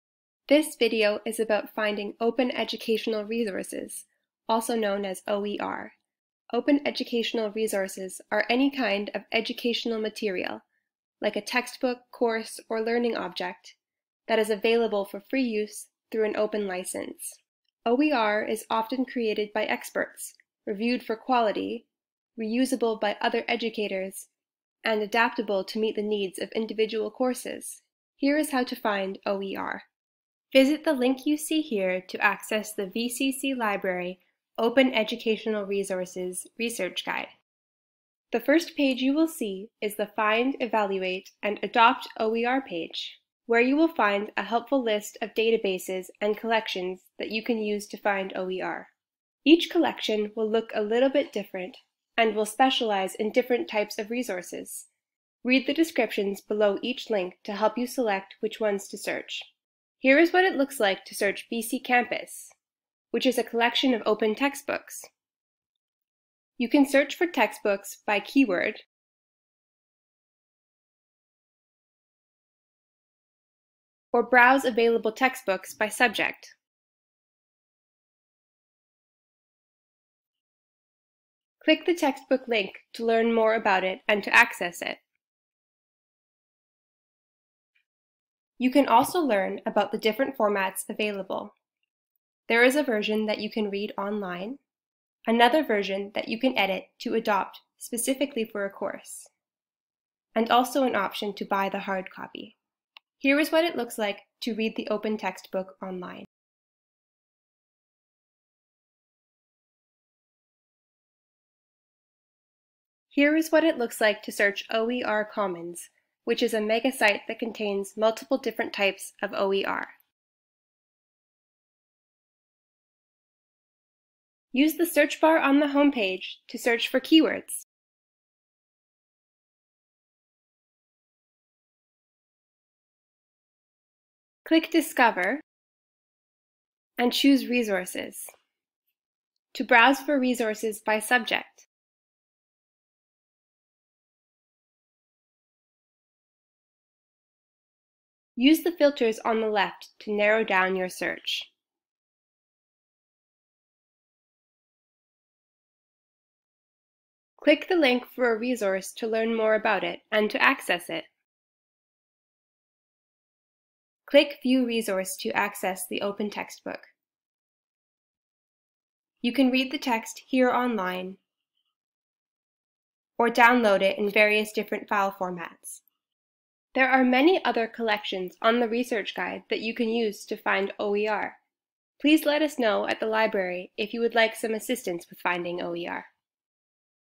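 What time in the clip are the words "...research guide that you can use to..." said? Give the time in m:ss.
2:58.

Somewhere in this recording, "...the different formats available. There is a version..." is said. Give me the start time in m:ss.
1:29.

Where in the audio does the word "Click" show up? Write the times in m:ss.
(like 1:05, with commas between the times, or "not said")
1:21, 2:14, 2:37, 2:44.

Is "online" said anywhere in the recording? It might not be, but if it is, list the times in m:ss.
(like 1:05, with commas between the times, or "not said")
1:33, 1:45, 2:50.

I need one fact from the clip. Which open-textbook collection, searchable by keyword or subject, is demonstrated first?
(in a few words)
BC Campus.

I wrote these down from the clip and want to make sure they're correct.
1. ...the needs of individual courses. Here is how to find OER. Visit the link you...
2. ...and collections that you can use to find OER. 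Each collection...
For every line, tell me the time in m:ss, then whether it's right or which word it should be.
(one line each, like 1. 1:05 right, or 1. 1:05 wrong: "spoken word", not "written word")
1. 0:25 right
2. 0:46 right.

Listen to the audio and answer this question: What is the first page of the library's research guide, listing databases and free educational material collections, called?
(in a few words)
Find, Evaluate, and Adopt OER.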